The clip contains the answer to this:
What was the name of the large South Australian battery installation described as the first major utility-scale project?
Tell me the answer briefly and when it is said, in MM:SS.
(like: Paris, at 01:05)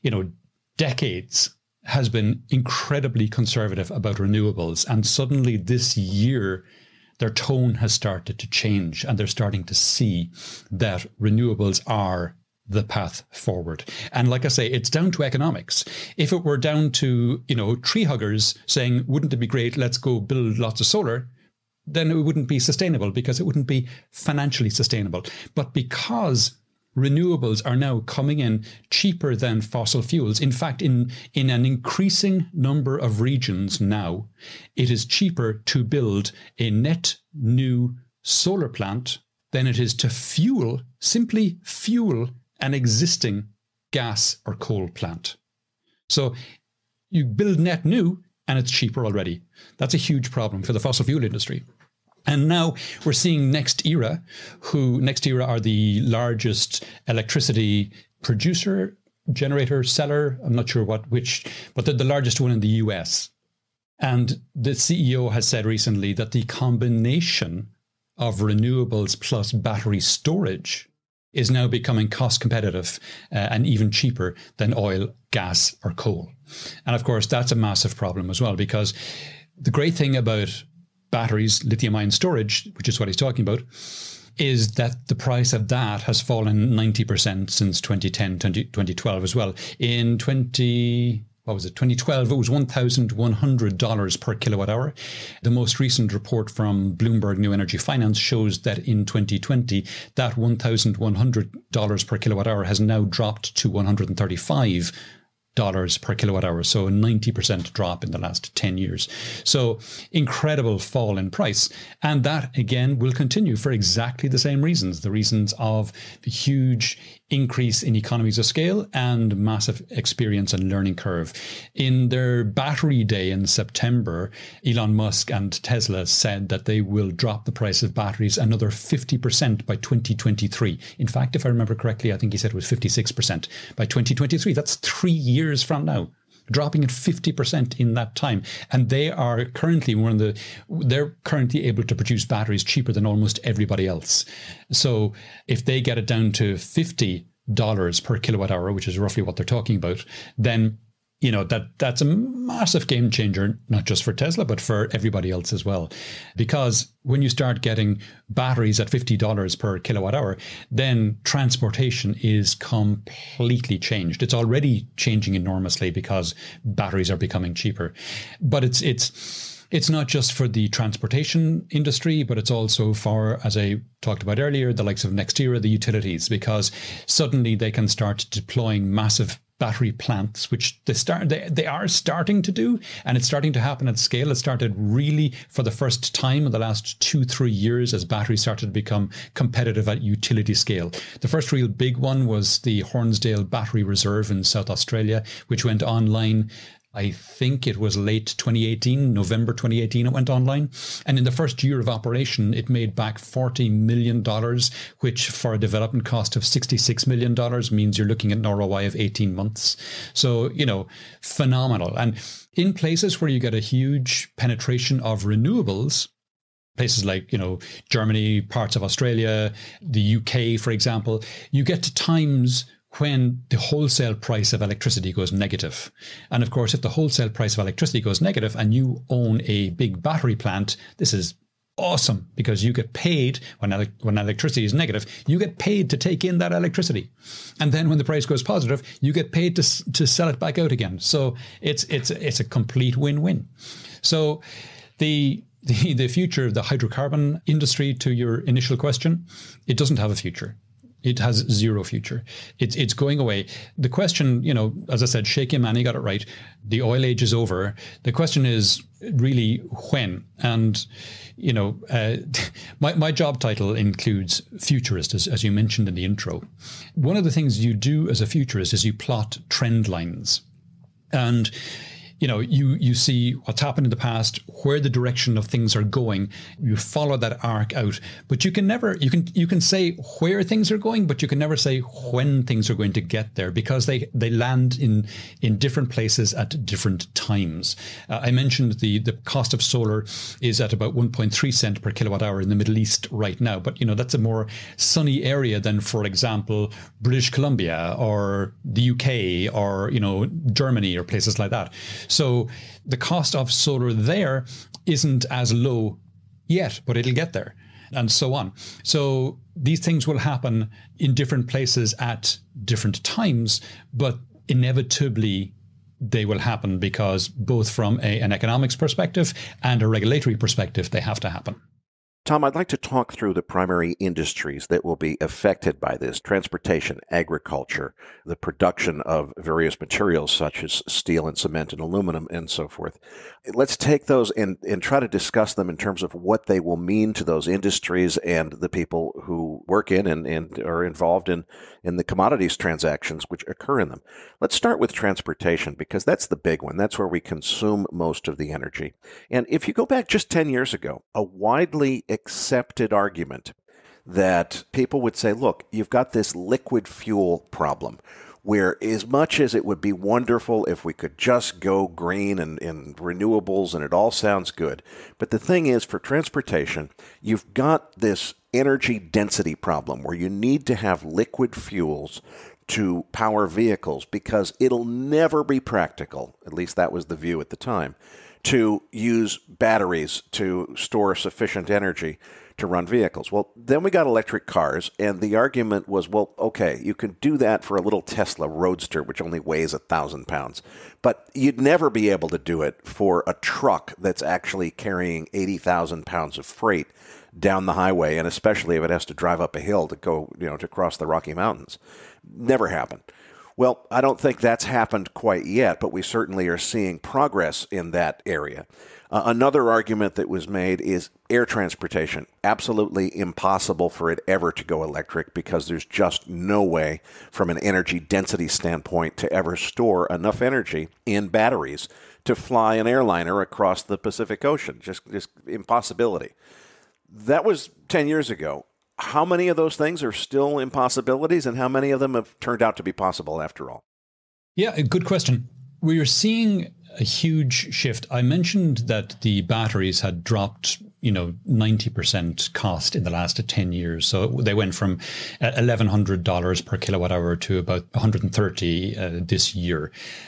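Hornsdale Battery Reserve, at 03:12.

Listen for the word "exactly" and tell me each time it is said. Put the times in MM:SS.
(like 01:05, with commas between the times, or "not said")
01:53.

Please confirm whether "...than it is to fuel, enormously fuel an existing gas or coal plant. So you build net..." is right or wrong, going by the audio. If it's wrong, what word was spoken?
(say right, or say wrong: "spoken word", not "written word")
wrong: "simply", not "enormously".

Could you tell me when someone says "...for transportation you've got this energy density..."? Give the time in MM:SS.
06:05.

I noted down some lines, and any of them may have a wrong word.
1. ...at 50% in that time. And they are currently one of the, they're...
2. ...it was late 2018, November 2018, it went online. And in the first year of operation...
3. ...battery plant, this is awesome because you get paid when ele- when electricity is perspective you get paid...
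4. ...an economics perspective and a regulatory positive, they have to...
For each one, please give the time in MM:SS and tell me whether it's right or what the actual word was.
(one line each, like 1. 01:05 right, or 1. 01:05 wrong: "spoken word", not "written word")
1. 02:16 right
2. 03:17 right
3. 03:50 wrong: "negative", not "perspective"
4. 05:18 wrong: "perspective", not "positive".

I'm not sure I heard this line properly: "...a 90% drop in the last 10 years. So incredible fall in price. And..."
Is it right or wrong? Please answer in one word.
right.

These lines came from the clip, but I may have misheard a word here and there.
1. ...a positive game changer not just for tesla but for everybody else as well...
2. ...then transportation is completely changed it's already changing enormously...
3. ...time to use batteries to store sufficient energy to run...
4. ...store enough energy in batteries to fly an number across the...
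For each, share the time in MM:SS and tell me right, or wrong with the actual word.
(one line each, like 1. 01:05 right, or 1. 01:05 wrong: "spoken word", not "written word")
1. 02:32 wrong: "massive", not "positive"
2. 02:40 right
3. 06:17 right
4. 06:59 wrong: "airliner", not "number".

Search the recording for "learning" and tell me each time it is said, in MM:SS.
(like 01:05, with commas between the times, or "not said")
02:00.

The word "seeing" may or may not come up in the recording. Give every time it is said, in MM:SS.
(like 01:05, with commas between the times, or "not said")
00:53, 06:46, 07:16.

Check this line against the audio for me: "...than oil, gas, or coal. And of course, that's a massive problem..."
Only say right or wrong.
right.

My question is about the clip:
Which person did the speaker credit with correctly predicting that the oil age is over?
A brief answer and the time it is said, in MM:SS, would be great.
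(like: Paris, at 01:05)
Sheikh Yamani, at 04:15.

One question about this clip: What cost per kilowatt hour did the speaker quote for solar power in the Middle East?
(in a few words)
1.3 cents.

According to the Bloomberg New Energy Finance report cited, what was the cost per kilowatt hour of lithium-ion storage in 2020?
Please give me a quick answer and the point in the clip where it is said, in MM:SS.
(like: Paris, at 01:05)
$135, at 01:43.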